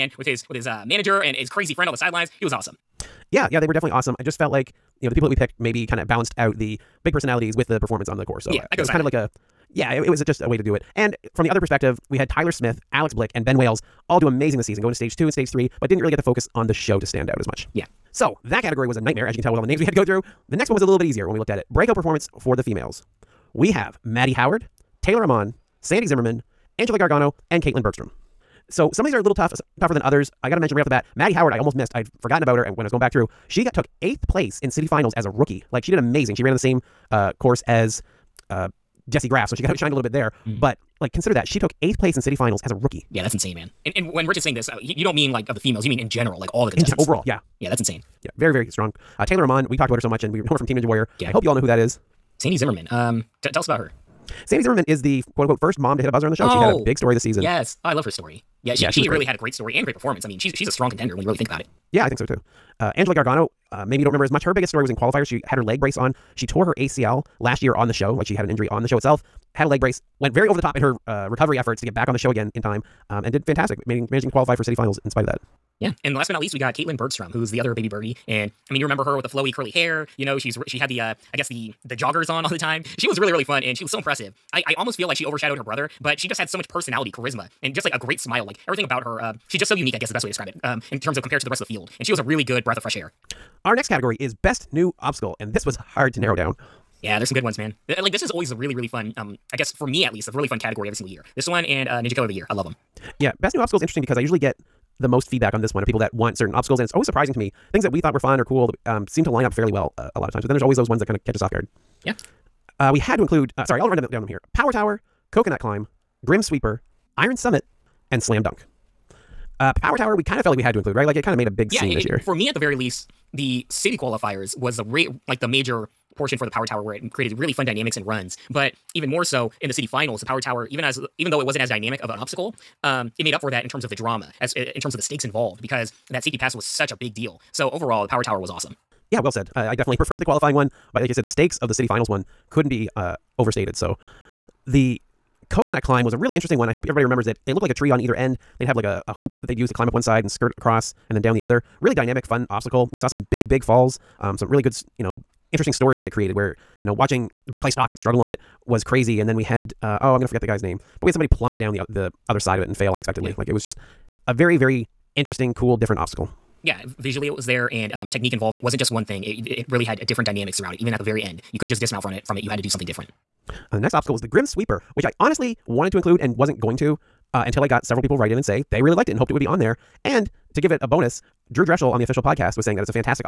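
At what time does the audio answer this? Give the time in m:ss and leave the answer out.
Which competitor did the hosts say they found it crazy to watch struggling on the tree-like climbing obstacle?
2:37.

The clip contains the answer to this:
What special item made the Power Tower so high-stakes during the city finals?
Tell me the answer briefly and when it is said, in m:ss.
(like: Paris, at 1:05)
safety pass, at 2:16.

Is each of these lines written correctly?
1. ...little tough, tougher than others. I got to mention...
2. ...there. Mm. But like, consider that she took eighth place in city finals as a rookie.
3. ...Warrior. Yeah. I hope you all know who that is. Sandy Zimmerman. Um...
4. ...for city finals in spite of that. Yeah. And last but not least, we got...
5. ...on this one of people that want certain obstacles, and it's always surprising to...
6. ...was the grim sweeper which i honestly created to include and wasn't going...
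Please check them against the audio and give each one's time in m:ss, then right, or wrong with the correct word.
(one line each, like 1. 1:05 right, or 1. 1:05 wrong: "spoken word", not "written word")
1. 0:29 right
2. 0:40 right
3. 0:50 right
4. 1:14 right
5. 1:45 right
6. 2:54 wrong: "wanted", not "created".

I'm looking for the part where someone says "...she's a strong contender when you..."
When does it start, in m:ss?
1:00.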